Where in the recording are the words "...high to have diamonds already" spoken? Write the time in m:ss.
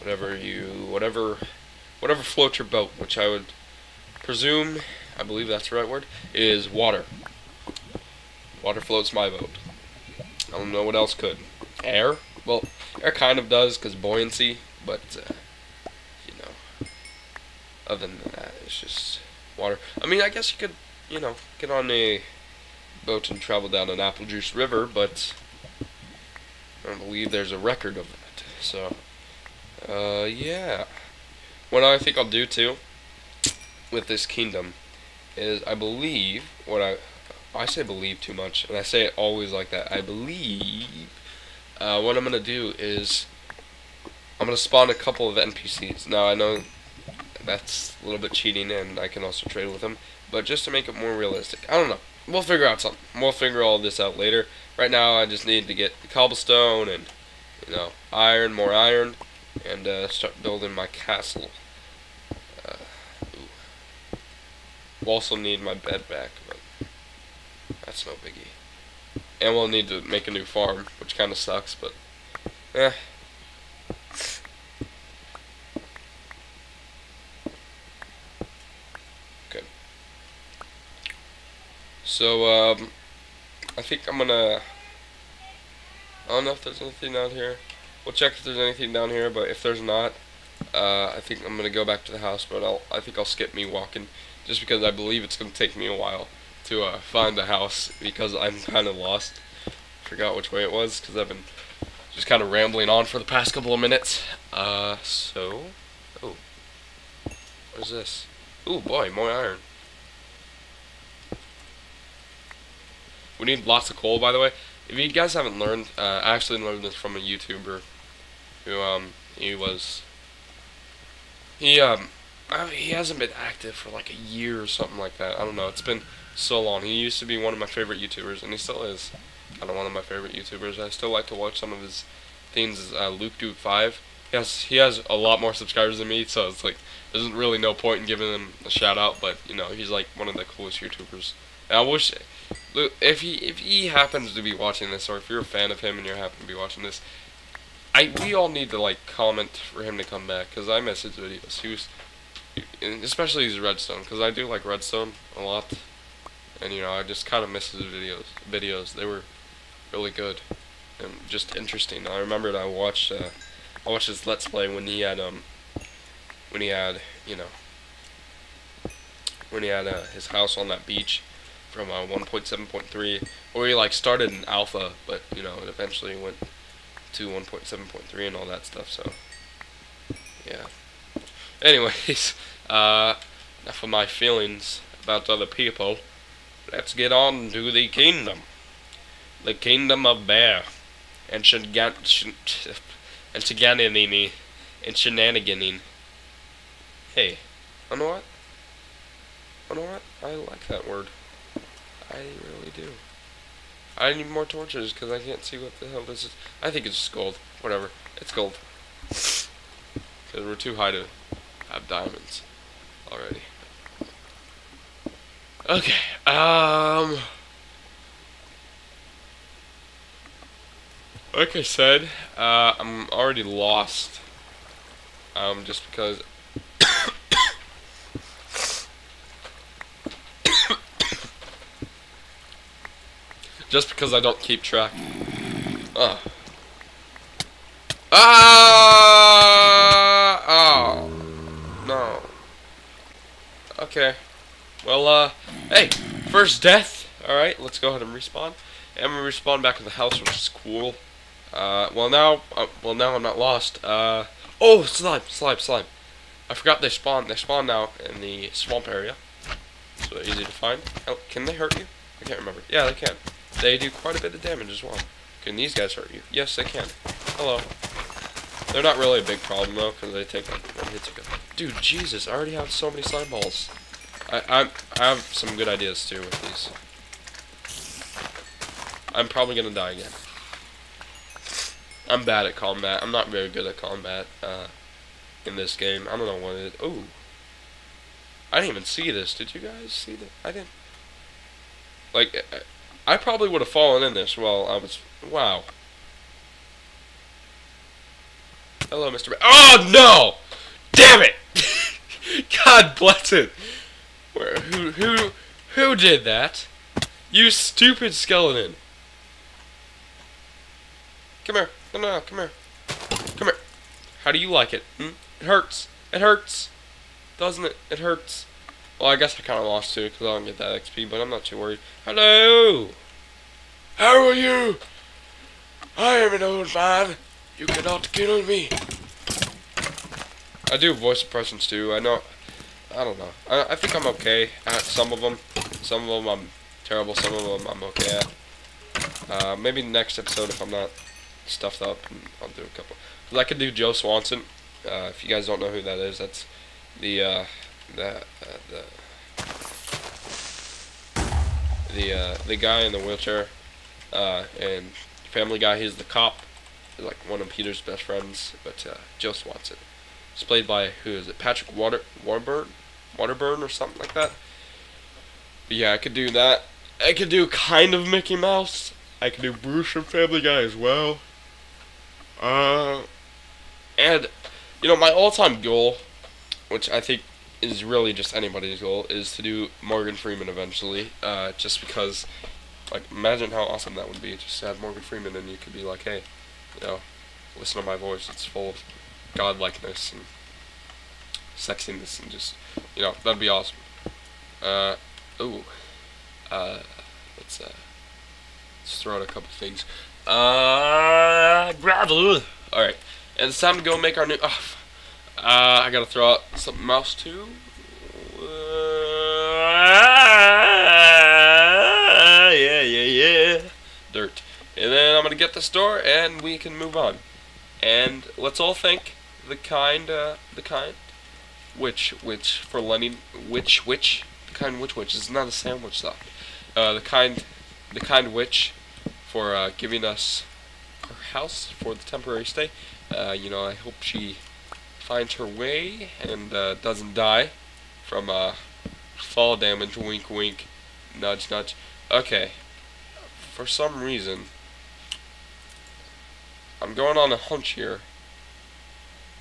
3:30.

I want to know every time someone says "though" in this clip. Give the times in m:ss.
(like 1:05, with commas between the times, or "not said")
4:29, 7:06.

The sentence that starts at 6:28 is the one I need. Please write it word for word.
It's full of godlikeness and sexiness, and just you know, that'd be awesome.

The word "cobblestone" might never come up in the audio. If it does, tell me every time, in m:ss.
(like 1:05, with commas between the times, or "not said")
0:56.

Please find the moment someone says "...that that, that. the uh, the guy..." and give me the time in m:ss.
5:47.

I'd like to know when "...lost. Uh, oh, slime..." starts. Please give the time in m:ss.
4:13.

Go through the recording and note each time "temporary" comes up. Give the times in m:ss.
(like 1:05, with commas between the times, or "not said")
7:12.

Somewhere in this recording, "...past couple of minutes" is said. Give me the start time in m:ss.
1:43.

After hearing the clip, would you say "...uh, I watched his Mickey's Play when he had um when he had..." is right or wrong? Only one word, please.
wrong.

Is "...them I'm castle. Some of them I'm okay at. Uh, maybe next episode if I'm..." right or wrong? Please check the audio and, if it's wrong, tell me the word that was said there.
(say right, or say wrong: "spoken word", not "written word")
wrong: "terrible", not "castle".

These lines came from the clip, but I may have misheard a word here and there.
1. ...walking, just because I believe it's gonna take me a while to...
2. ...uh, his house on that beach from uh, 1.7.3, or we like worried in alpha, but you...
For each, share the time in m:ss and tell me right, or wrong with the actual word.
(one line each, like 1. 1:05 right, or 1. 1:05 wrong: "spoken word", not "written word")
1. 1:33 right
2. 2:49 wrong: "started", not "worried".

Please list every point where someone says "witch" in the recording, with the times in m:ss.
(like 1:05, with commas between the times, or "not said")
7:02, 7:08.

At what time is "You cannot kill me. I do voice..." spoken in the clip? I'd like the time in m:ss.
5:27.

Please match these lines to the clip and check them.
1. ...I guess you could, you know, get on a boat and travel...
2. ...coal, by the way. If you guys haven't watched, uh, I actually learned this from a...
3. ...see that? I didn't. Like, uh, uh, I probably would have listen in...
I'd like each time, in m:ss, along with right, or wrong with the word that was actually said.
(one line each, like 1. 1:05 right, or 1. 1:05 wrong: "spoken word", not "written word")
1. 0:20 right
2. 1:53 wrong: "learned", not "watched"
3. 4:49 wrong: "fallen", not "listen".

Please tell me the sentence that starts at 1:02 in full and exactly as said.
Uh, we'll also need my bed back, but that's no biggie.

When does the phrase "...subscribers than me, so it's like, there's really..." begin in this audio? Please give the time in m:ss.
2:15.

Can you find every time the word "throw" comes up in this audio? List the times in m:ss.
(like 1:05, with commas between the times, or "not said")
6:39, 6:46.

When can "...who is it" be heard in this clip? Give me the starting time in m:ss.
6:01.